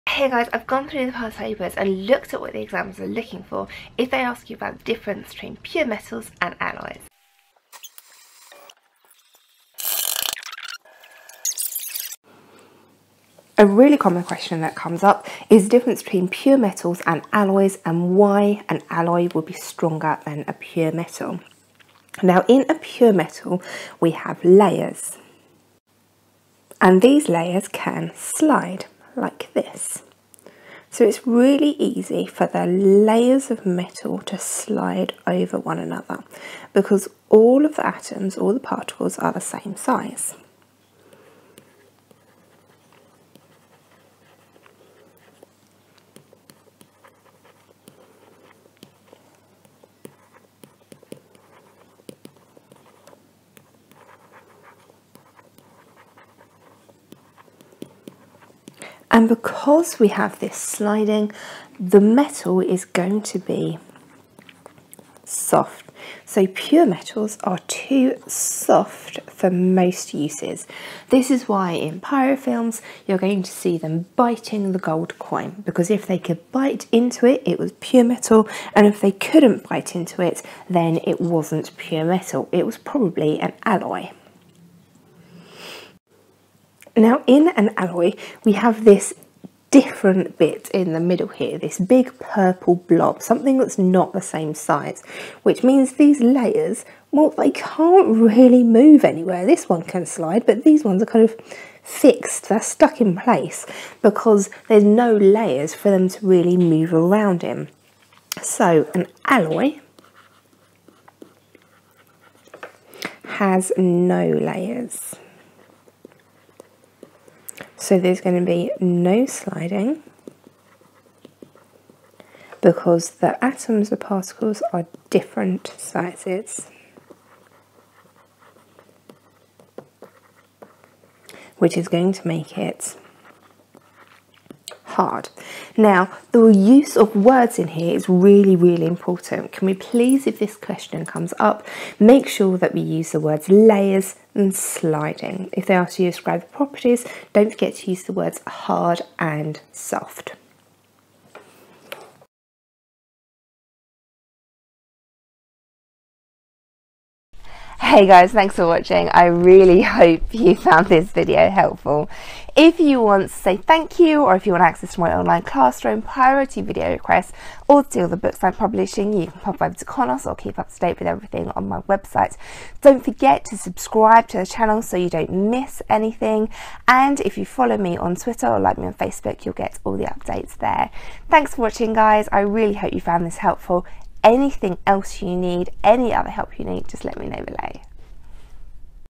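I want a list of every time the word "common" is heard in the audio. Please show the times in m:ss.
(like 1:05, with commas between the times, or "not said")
0:13.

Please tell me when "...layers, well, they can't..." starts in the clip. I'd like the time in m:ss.
1:36.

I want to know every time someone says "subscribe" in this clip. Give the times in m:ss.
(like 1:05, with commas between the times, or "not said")
2:53.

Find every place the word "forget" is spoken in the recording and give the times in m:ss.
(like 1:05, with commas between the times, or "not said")
2:27, 2:53.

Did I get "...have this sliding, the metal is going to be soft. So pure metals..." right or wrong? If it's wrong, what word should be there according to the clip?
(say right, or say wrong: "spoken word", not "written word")
right.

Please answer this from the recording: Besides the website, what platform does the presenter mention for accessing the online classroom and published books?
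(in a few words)
Conos.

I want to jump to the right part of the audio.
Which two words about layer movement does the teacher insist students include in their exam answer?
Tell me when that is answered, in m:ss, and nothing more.
2:23.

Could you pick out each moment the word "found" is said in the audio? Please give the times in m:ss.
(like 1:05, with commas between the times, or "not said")
2:40, 3:03.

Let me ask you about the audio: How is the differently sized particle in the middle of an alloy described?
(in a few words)
big purple blob.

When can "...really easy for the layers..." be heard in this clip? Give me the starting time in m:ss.
0:31.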